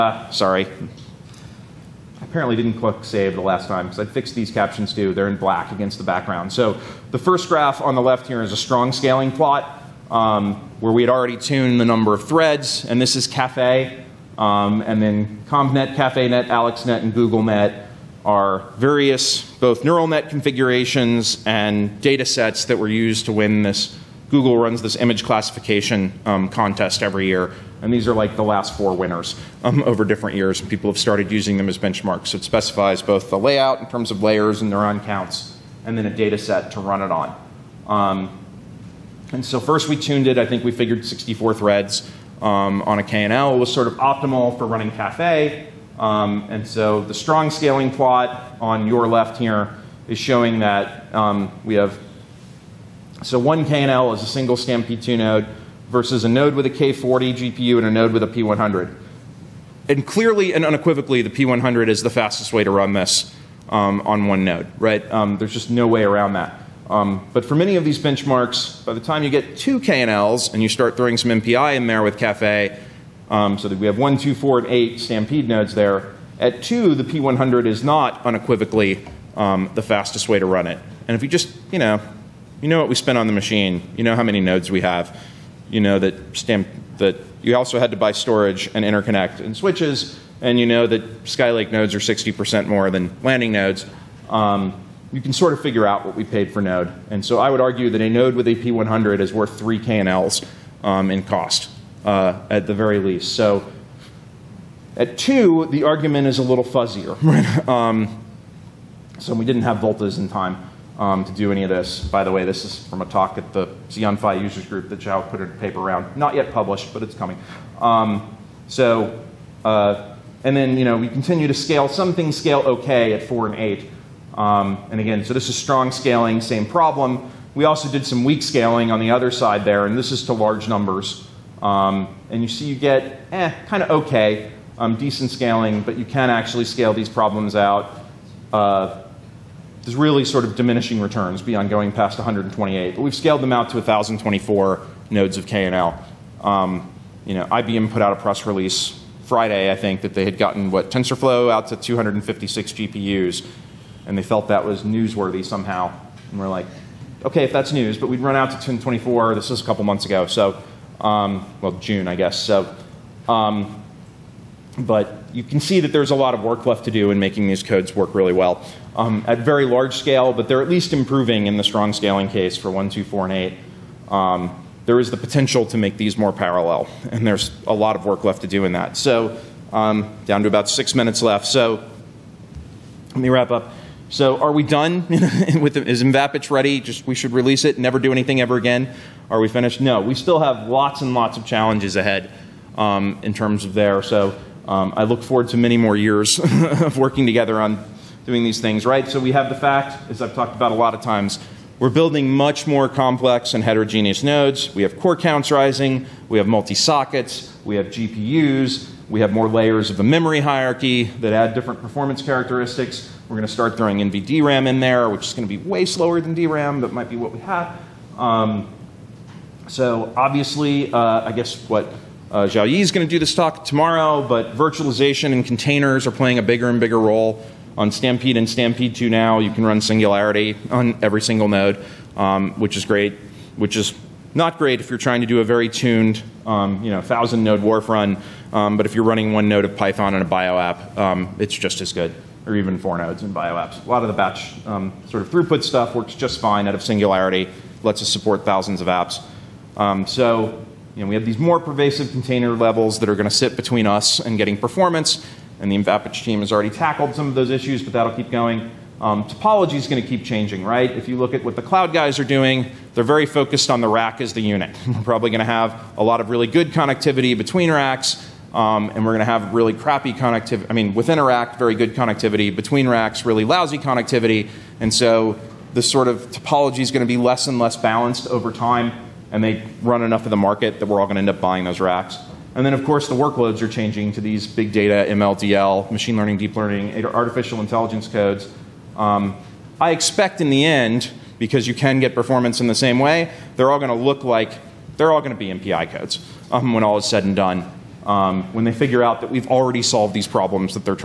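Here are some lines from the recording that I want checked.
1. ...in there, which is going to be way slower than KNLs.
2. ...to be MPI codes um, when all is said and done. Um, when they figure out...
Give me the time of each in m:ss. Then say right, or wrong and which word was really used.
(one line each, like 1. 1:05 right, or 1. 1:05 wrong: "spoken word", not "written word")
1. 3:34 wrong: "DRAM", not "KNLs"
2. 4:55 right.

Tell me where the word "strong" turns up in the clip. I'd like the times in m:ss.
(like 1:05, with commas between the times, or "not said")
0:08, 0:47, 2:05, 2:51.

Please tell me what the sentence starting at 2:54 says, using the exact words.
Um, there is the potential to make these more parallel, and there's a lot of work left to do in that.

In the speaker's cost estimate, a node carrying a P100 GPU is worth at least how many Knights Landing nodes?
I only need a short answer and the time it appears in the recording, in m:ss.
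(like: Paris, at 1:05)
3, at 1:39.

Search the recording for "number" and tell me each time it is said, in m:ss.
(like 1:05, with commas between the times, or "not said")
0:11, 2:10.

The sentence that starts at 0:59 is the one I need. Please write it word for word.
And clearly and unequivocally, the P100 is the fastest way to run this um, on one node, right?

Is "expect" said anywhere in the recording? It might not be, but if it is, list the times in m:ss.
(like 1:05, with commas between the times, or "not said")
4:49.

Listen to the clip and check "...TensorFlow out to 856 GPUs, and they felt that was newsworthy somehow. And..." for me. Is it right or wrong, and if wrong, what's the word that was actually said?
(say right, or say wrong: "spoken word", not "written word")
wrong: "256", not "856".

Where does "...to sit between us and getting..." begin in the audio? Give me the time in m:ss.
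4:13.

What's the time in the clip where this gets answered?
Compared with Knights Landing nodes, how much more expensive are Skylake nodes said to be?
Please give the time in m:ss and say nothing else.
1:31.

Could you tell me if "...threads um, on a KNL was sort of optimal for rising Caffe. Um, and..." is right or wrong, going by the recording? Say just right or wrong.
wrong.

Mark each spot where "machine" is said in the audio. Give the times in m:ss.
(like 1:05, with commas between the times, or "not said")
1:23, 4:45.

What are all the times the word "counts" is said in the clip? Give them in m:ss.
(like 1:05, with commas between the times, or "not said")
0:35, 3:25.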